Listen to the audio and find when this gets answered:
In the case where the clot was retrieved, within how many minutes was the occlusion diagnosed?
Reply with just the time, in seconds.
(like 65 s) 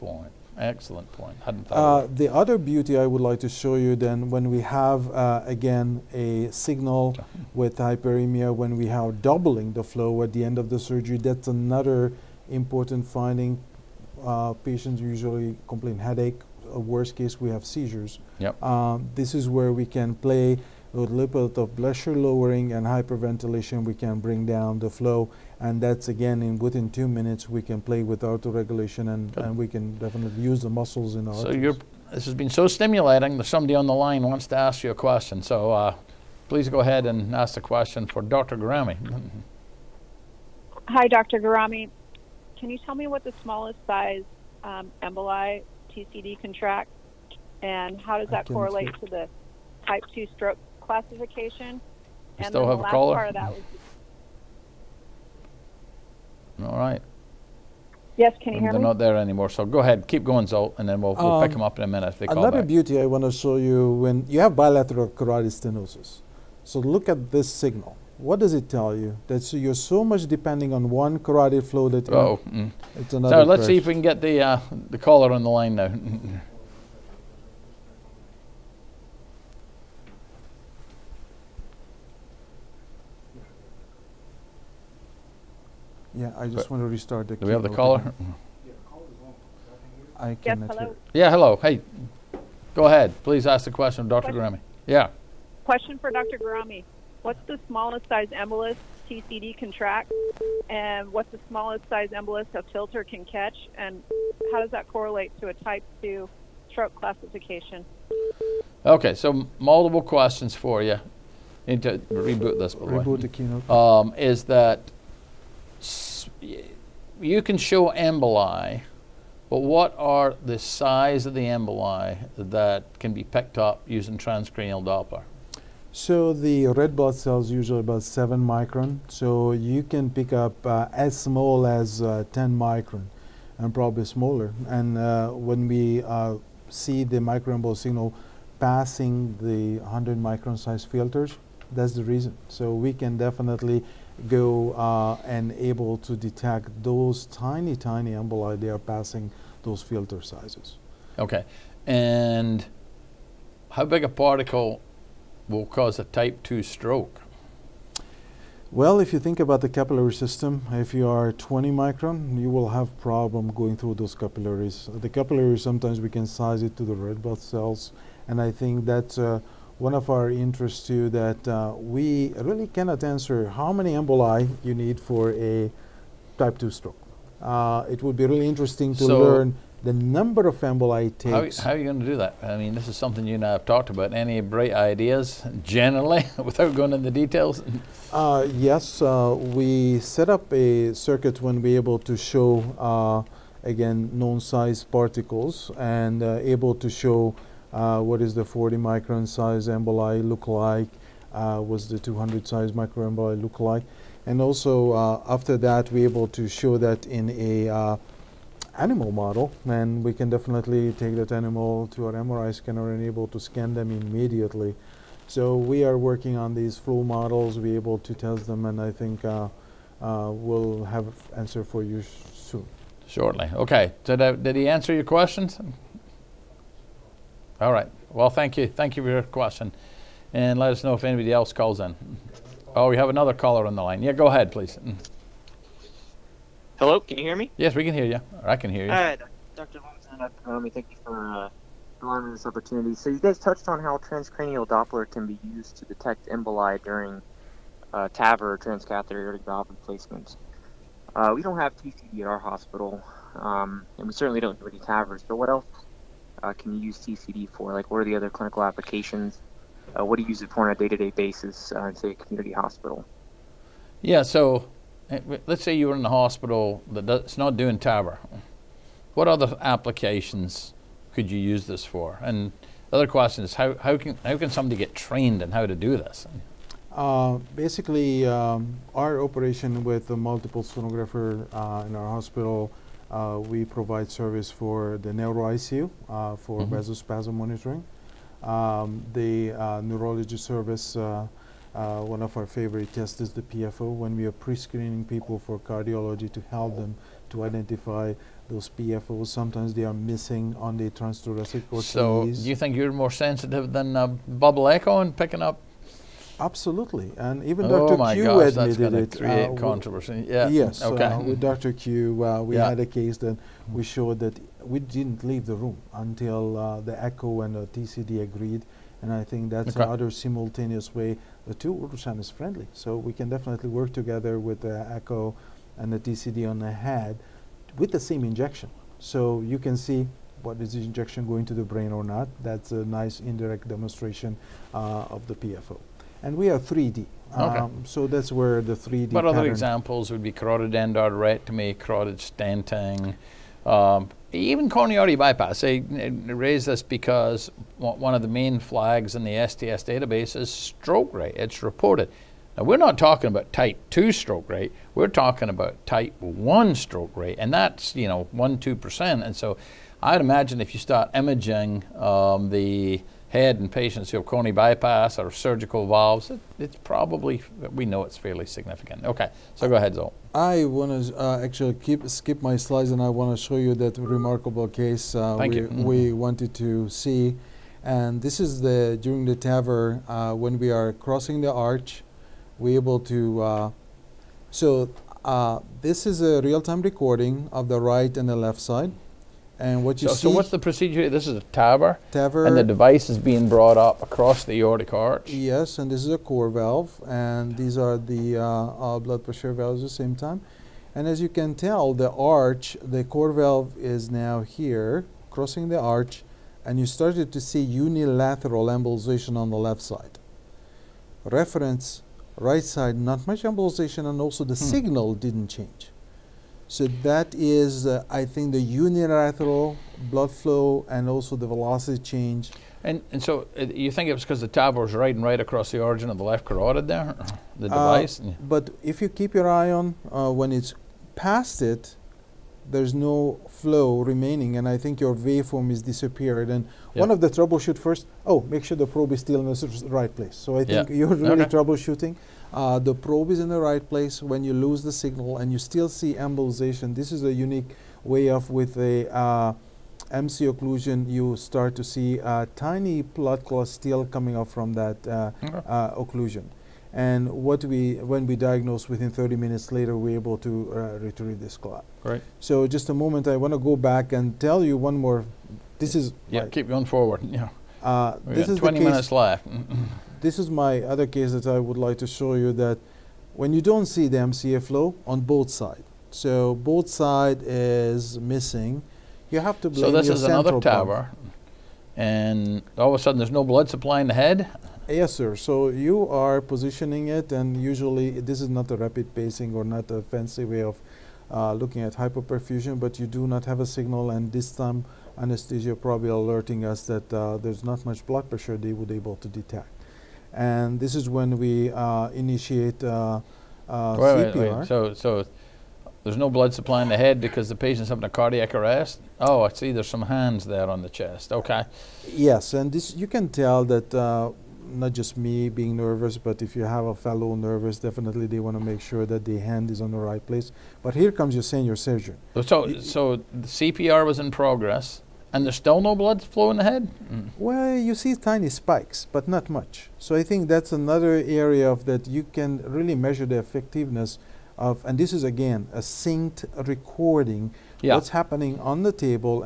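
459 s.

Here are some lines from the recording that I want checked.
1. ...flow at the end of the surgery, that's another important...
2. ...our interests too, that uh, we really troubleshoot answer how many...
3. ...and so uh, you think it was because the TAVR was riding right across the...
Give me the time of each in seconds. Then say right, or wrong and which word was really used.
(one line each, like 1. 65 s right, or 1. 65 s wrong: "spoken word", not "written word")
1. 9 s right
2. 170 s wrong: "cannot", not "troubleshoot"
3. 423 s right.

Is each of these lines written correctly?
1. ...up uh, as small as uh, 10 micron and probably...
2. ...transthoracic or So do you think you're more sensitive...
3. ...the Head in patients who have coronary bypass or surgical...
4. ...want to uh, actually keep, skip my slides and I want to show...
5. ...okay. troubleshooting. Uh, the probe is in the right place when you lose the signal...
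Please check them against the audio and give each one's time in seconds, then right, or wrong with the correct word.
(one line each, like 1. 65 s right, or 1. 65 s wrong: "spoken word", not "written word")
1. 130 s right
2. 300 s right
3. 362 s right
4. 370 s right
5. 441 s right.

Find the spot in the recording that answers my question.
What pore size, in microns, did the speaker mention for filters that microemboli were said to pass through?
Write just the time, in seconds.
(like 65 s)
139 s.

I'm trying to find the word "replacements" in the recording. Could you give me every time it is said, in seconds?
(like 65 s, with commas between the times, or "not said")
249 s.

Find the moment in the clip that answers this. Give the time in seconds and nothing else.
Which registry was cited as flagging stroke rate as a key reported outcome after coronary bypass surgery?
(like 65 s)
349 s.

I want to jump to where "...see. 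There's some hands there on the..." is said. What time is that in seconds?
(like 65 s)
509 s.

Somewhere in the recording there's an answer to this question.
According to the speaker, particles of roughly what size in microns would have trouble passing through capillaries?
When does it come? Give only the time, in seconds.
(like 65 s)
161 s.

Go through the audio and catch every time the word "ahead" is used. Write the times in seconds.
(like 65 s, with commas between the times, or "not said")
36 s, 59 s, 92 s, 234 s, 369 s.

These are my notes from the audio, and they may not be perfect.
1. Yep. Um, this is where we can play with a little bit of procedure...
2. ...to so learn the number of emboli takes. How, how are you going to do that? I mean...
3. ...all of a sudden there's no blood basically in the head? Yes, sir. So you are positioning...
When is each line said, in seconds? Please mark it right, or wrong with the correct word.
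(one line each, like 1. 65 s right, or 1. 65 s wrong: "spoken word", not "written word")
1. 18 s wrong: "pressure", not "procedure"
2. 178 s right
3. 482 s wrong: "supply", not "basically".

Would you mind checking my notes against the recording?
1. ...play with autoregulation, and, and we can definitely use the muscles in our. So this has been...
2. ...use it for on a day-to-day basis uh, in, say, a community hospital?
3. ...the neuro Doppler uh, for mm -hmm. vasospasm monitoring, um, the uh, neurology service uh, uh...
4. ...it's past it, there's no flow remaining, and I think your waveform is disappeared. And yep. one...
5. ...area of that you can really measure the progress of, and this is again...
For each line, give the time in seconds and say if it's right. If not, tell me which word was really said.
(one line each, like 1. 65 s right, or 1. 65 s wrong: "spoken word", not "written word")
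1. 27 s right
2. 260 s right
3. 285 s wrong: "ICU", not "Doppler"
4. 430 s right
5. 531 s wrong: "effectiveness", not "progress".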